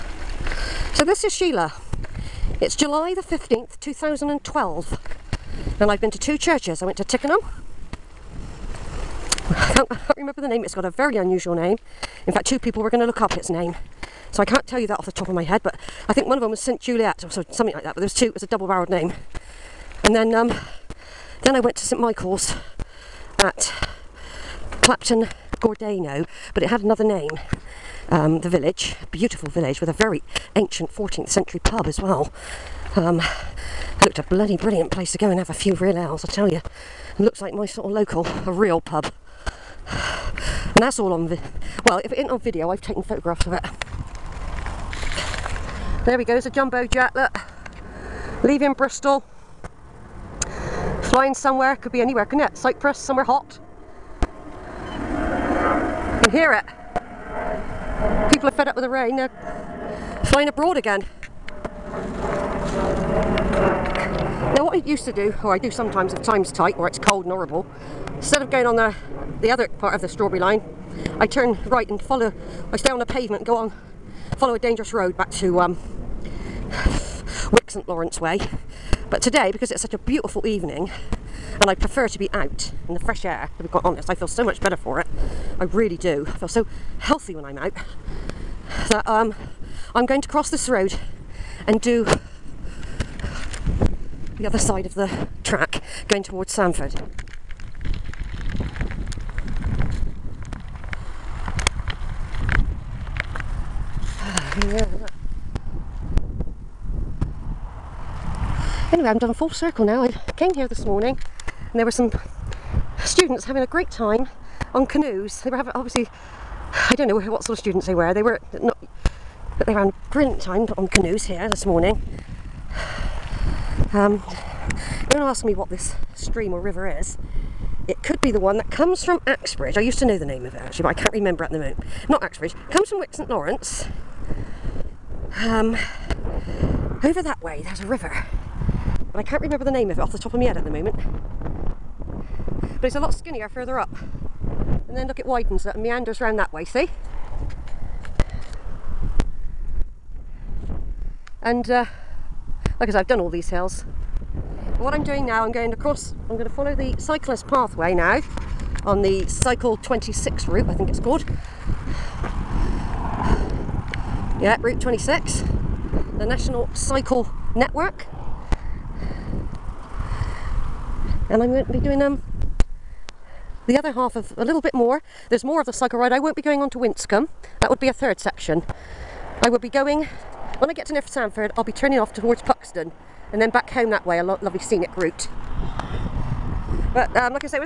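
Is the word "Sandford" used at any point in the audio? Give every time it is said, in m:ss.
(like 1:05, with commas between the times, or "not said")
1:36, 3:01.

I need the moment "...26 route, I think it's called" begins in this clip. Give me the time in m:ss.
2:39.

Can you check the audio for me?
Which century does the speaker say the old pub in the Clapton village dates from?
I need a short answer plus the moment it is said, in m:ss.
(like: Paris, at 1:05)
14th century, at 0:30.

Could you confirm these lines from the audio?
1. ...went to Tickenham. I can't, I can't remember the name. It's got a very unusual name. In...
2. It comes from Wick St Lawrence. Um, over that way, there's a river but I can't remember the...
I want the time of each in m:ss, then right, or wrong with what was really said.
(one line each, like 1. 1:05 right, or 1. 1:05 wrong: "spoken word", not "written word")
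1. 0:06 right
2. 2:12 right.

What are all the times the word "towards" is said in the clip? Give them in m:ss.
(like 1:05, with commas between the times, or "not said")
1:36, 3:02.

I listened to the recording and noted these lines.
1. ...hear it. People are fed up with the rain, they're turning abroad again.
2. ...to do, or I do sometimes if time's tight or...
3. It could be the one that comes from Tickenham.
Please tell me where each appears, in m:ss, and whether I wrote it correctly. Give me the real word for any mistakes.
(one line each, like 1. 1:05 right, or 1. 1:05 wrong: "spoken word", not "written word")
1. 0:56 wrong: "flying", not "turning"
2. 1:05 right
3. 2:07 wrong: "Axbridge", not "Tickenham".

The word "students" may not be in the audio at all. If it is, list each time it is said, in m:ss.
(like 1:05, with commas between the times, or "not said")
1:53, 1:57.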